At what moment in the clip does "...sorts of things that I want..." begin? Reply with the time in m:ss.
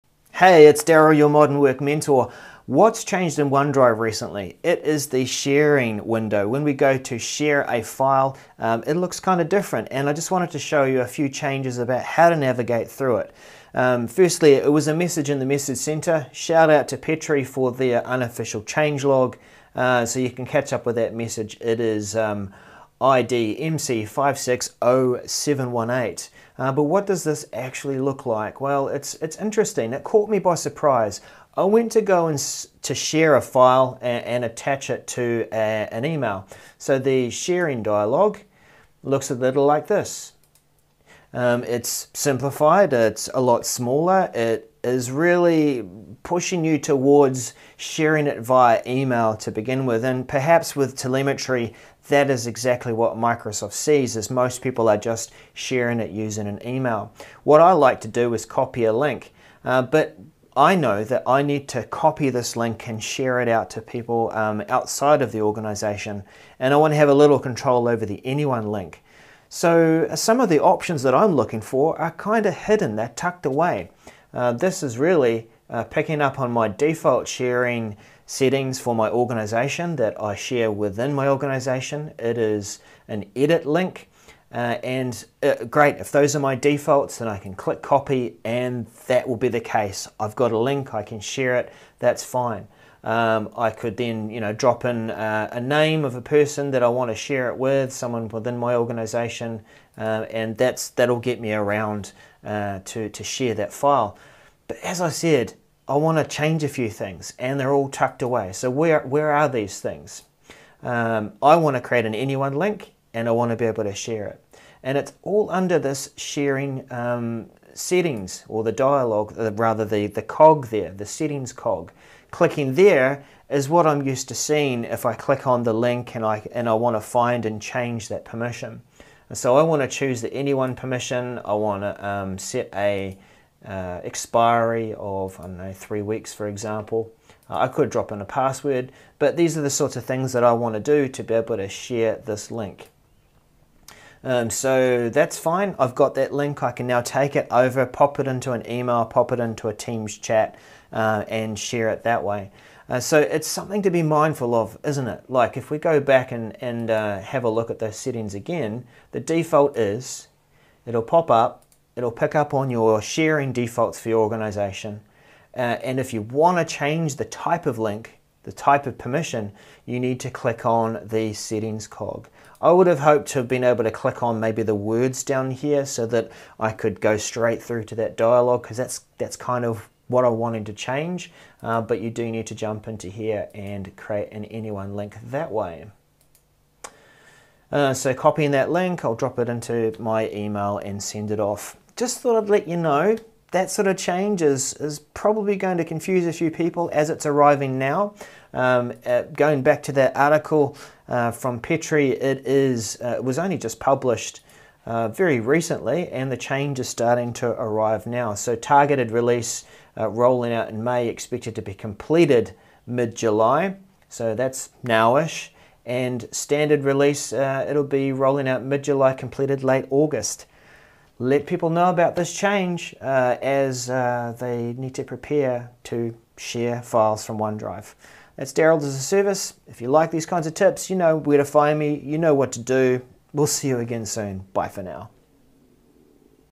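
2:19.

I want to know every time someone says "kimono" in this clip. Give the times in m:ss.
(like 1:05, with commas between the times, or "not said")
not said.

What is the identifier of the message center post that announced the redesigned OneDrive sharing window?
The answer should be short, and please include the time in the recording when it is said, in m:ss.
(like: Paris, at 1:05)
MC560718, at 0:23.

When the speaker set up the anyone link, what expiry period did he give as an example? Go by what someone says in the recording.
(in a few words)
3 weeks.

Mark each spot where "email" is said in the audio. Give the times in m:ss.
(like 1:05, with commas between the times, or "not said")
0:36, 0:48, 0:56, 2:28, 3:10.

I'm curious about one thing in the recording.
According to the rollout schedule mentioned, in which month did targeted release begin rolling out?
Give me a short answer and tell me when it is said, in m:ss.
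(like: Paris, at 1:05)
May, at 3:30.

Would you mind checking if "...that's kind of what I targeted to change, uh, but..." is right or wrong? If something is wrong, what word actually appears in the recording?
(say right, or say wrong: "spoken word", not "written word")
wrong: "wanted", not "targeted".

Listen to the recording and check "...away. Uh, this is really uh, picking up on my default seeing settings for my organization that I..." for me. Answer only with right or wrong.
wrong.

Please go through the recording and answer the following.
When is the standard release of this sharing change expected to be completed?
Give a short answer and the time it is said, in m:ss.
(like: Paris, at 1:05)
Late August, at 3:39.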